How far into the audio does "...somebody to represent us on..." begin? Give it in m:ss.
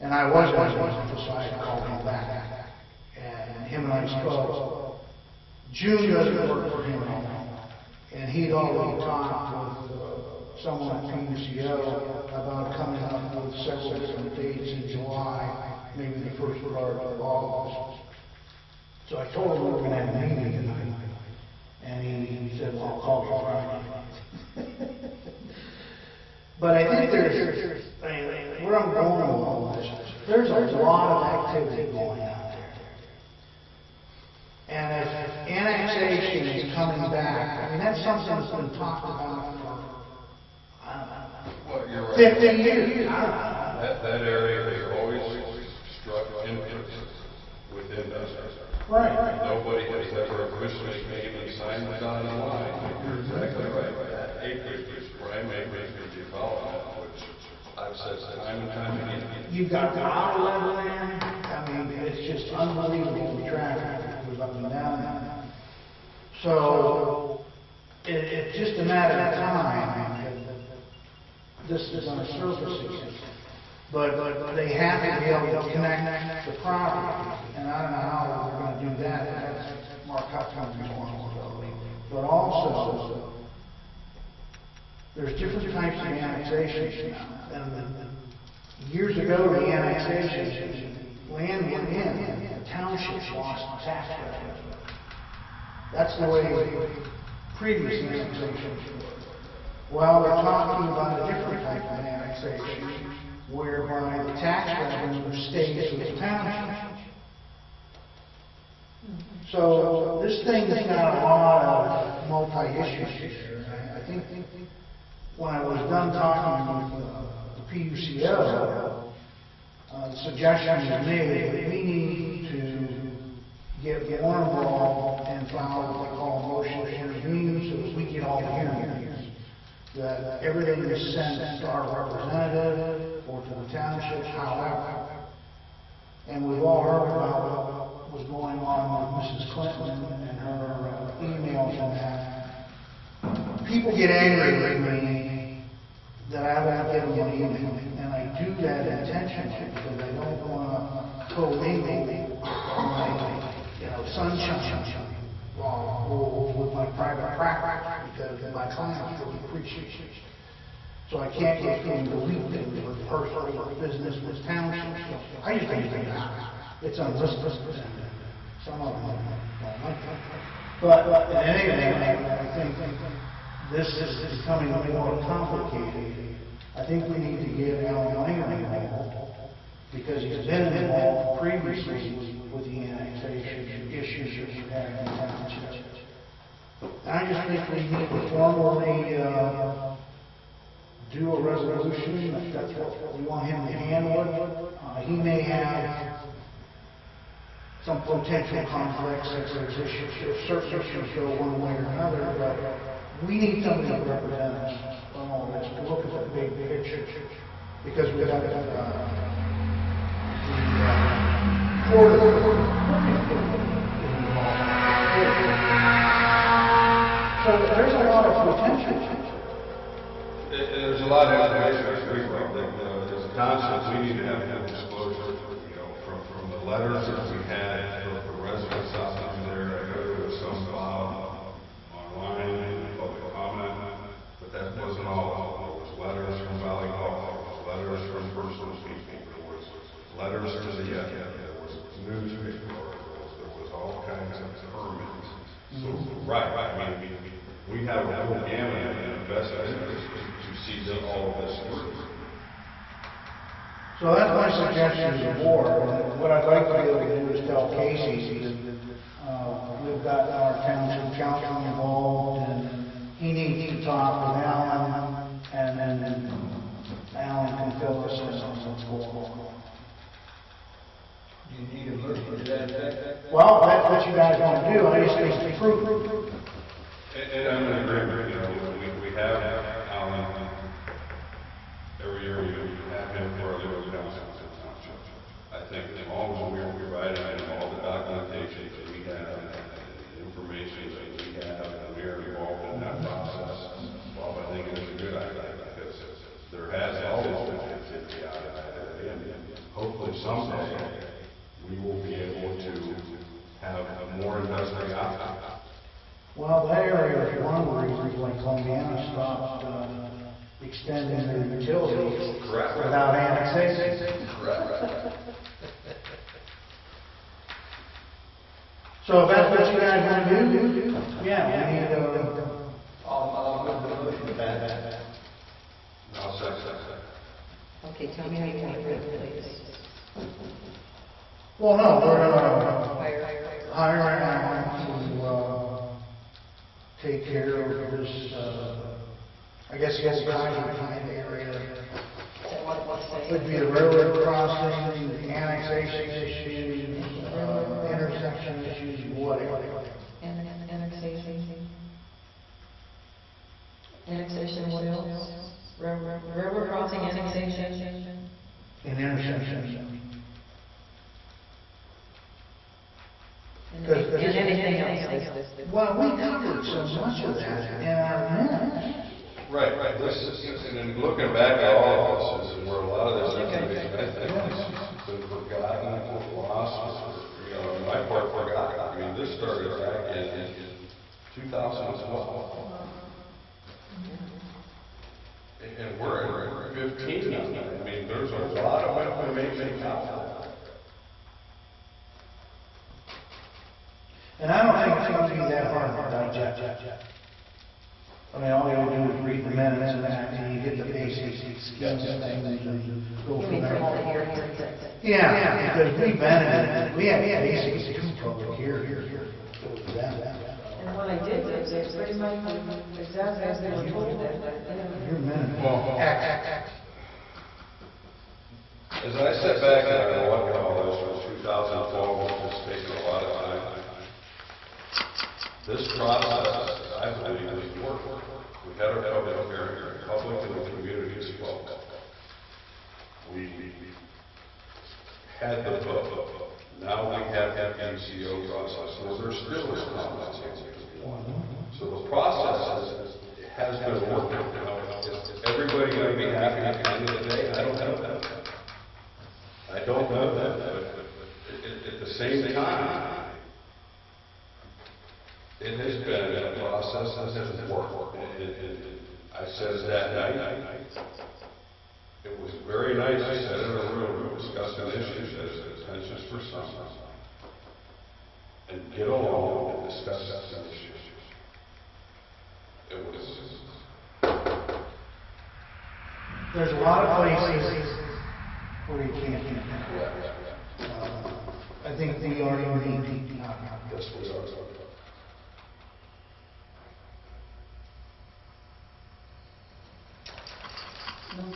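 3:23.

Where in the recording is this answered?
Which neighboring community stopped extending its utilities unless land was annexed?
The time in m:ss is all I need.
5:08.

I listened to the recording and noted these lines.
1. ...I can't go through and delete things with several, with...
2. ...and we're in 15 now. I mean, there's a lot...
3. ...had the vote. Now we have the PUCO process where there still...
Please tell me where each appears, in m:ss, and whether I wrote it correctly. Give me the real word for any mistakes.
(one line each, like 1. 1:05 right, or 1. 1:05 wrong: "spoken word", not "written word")
1. 2:41 wrong: "personal", not "several"
2. 6:25 right
3. 7:15 right.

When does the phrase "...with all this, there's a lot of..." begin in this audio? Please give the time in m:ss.
0:29.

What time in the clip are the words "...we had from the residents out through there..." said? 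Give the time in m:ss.
3:47.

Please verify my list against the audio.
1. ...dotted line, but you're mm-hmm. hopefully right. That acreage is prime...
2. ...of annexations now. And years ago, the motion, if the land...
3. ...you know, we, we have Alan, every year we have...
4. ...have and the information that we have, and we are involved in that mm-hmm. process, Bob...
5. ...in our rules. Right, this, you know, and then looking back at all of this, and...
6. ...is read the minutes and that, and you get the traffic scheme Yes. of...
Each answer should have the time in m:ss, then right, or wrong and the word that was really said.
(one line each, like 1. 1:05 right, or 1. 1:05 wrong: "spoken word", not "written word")
1. 0:51 wrong: "exactly", not "hopefully"
2. 1:26 wrong: "annexation", not "motion"
3. 4:38 right
4. 4:49 right
5. 6:07 wrong: "minutes", not "rules"
6. 6:39 wrong: "basic", not "traffic".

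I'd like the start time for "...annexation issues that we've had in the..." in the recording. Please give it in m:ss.
3:02.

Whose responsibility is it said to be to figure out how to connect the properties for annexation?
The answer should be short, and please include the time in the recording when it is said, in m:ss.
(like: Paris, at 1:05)
Mark Hudson, at 1:20.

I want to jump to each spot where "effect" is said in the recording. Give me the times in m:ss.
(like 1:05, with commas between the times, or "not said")
4:32.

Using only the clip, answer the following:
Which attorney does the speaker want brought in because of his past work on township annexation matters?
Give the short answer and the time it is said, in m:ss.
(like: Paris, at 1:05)
Alan Langer, at 2:57.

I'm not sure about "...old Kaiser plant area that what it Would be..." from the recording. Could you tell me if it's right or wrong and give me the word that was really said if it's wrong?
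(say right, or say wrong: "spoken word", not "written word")
right.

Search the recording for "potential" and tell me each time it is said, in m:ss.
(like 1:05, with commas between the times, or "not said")
3:18, 3:38.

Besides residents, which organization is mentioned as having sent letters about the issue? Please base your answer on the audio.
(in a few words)
Valley Golf.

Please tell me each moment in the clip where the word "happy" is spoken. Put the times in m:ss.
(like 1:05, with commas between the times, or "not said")
7:26.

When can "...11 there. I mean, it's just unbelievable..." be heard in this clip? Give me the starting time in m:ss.
1:00.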